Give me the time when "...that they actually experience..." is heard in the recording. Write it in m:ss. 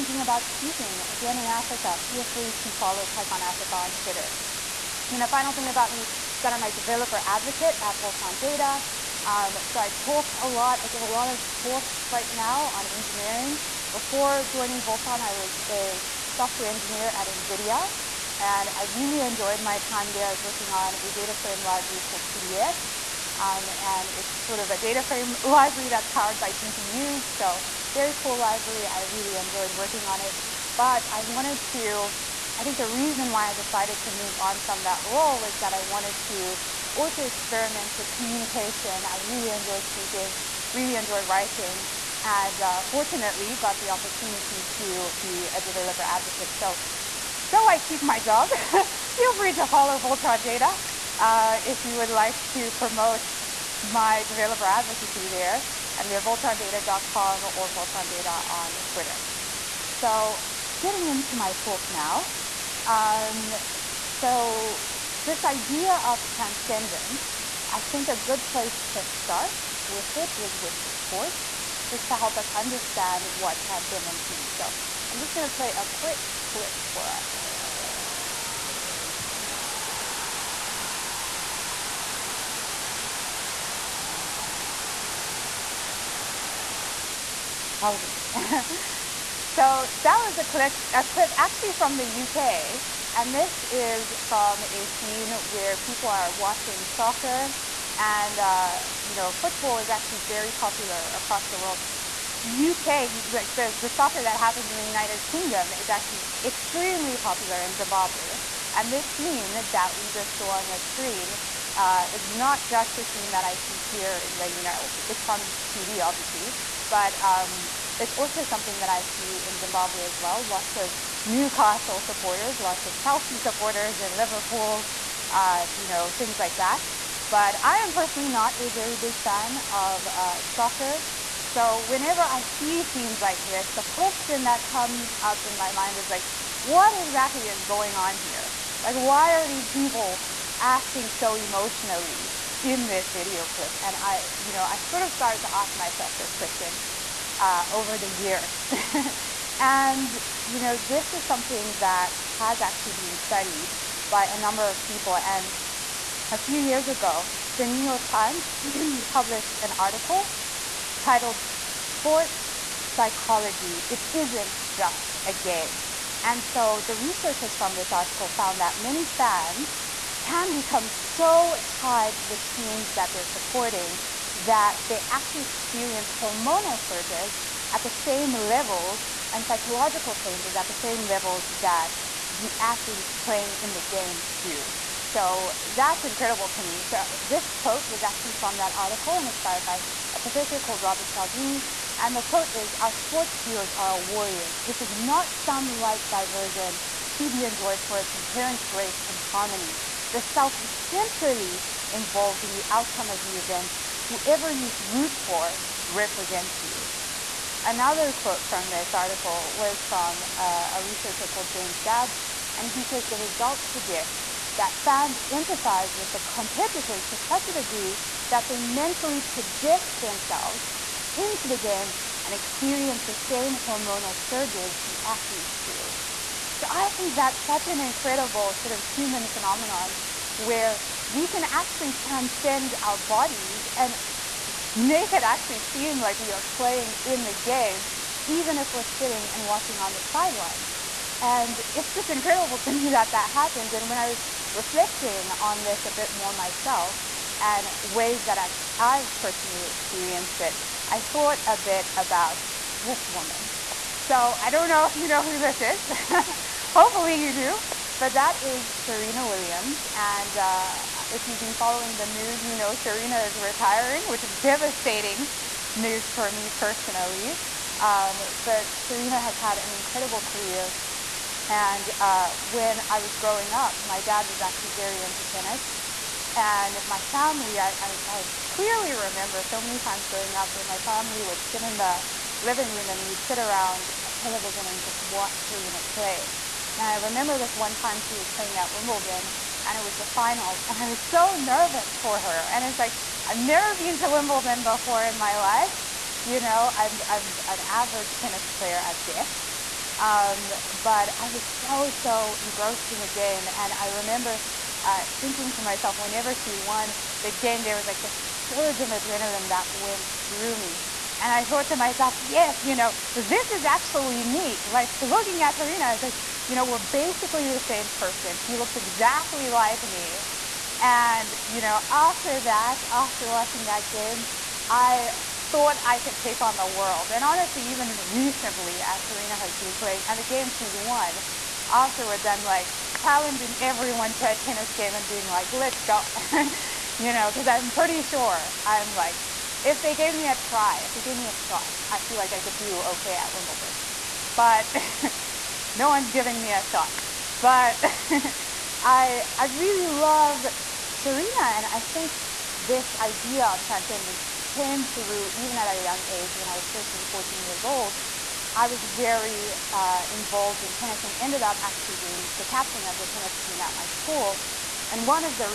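2:54.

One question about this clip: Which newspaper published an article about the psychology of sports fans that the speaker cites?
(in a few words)
The New York Times.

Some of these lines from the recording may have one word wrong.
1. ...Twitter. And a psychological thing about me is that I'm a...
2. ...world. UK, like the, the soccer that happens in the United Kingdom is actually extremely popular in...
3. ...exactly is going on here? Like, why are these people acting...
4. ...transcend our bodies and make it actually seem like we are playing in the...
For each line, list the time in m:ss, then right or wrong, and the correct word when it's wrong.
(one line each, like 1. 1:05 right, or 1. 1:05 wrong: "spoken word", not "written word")
1. 0:03 wrong: "final", not "psychological"
2. 1:41 right
3. 2:17 right
4. 3:51 right.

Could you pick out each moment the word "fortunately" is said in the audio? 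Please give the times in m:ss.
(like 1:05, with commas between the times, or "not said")
0:42.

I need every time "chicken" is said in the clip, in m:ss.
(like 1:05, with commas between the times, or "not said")
not said.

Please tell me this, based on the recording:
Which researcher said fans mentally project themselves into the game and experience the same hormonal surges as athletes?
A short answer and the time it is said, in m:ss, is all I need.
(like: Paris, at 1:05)
James Dabbs, at 3:31.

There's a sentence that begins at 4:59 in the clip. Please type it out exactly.
Um, but I was so, so engrossed in the game.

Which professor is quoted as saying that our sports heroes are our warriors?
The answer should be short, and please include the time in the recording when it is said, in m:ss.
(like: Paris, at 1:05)
Robert Cialdini, at 3:10.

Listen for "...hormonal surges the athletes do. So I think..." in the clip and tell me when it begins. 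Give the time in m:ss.
3:43.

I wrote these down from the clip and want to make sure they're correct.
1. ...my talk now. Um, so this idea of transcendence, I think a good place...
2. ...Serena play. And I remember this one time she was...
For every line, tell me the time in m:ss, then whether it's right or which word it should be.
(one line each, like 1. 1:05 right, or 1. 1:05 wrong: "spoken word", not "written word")
1. 1:01 right
2. 4:45 right.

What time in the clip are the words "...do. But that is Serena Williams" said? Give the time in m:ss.
4:17.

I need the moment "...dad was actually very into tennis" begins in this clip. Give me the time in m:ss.
4:34.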